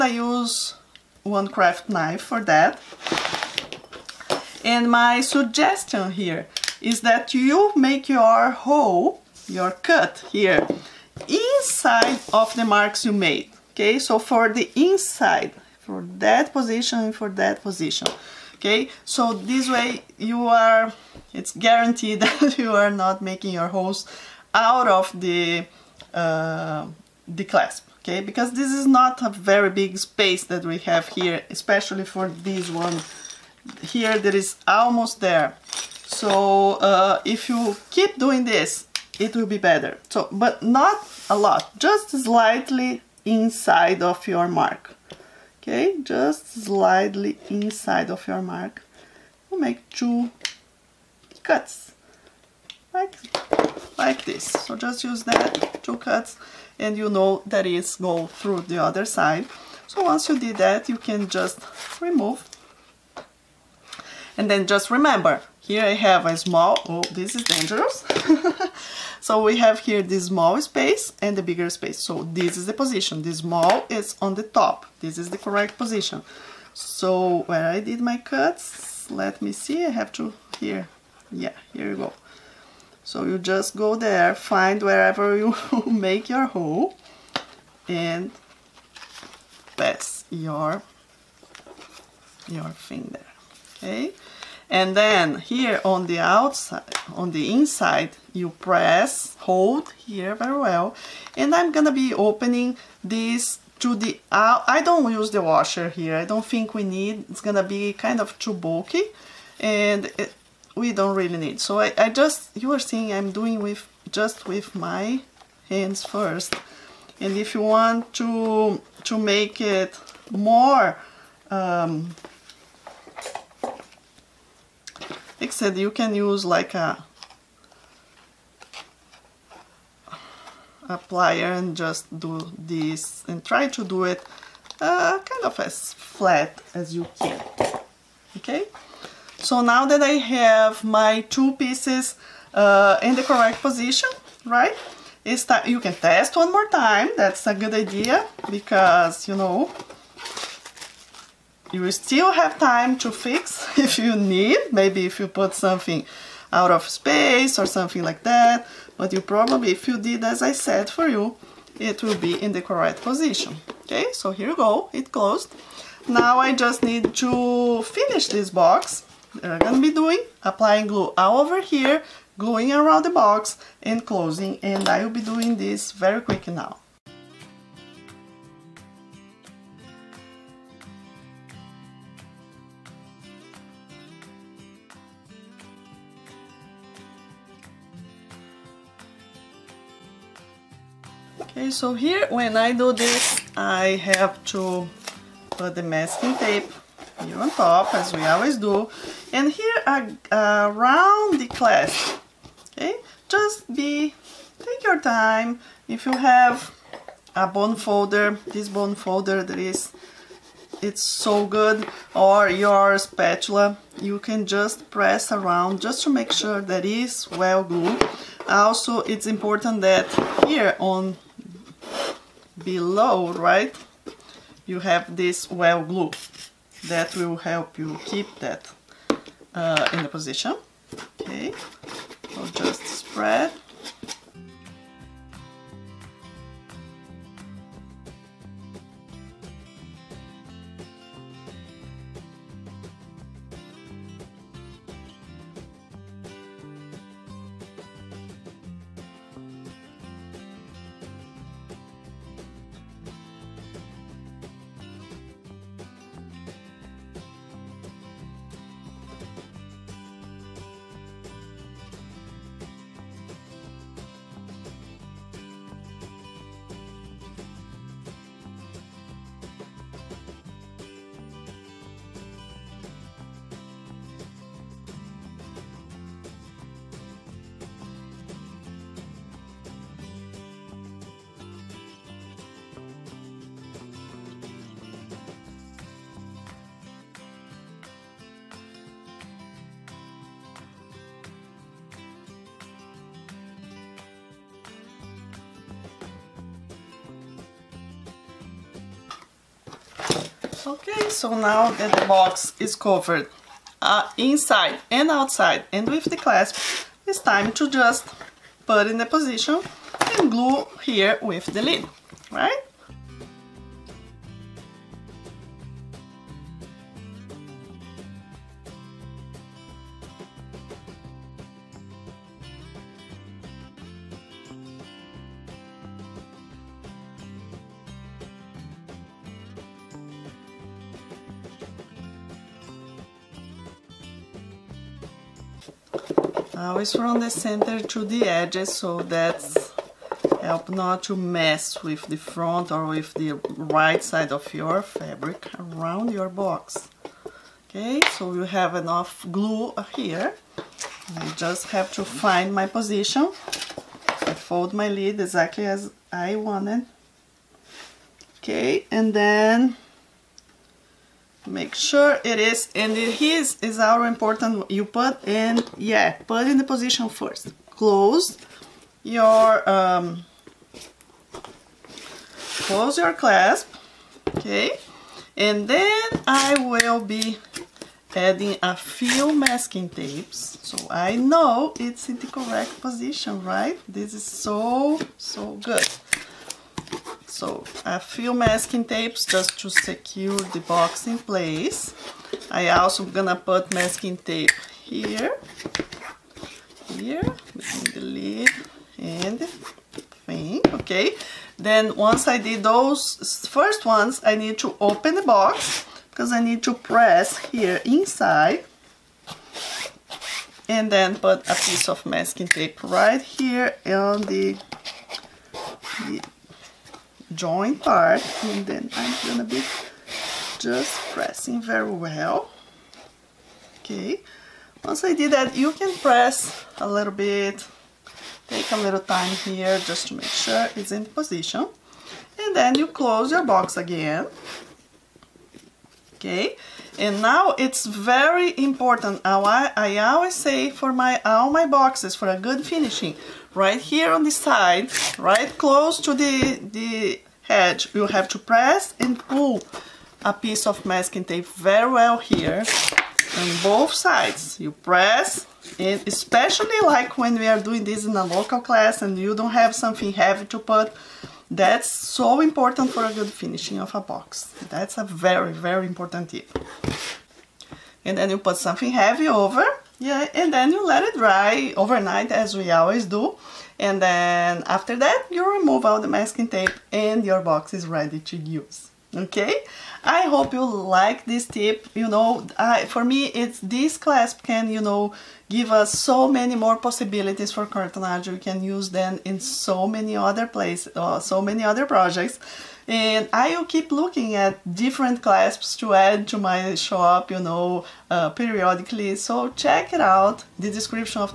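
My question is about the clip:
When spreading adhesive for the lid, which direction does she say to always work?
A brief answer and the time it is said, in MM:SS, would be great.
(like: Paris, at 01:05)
center to the edges, at 05:36.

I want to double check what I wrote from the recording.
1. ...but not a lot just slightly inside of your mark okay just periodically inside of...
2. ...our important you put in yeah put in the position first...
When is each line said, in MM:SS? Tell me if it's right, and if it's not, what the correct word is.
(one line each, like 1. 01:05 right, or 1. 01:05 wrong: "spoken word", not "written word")
1. 00:40 wrong: "slightly", not "periodically"
2. 06:03 right.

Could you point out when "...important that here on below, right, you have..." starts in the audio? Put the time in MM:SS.
03:39.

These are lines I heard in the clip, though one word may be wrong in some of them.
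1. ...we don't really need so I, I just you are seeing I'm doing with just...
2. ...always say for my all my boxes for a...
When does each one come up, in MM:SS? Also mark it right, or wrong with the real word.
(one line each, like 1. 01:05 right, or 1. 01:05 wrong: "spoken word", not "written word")
1. 01:50 right
2. 07:20 right.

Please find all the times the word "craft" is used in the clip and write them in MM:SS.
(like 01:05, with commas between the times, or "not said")
00:01.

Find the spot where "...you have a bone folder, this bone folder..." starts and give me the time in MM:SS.
03:26.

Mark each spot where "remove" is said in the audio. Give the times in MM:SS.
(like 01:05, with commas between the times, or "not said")
01:02, 07:55.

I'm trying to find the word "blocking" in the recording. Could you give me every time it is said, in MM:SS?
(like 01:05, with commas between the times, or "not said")
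not said.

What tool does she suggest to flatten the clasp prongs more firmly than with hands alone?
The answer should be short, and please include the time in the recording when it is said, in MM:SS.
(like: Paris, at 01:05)
plier, at 02:11.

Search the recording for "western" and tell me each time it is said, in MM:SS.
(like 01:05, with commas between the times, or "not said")
not said.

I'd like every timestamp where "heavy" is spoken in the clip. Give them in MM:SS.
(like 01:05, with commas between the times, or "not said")
07:40, 07:48.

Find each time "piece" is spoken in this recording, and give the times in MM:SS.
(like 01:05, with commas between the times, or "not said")
02:21, 06:51, 07:30.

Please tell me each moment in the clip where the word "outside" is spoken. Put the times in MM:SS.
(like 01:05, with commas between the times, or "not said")
01:36, 05:05.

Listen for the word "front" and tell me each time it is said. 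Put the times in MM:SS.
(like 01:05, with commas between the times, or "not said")
05:42.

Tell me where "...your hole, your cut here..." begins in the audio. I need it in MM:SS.
00:08.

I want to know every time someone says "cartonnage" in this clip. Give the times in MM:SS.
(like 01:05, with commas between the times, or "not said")
08:07.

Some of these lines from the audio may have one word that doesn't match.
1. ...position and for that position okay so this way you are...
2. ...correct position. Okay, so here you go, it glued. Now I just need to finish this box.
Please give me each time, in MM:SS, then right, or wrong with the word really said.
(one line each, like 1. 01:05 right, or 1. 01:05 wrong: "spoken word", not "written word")
1. 00:16 right
2. 02:42 wrong: "closed", not "glued".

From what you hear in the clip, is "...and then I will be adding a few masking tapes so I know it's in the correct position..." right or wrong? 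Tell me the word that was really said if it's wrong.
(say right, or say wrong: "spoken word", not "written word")
right.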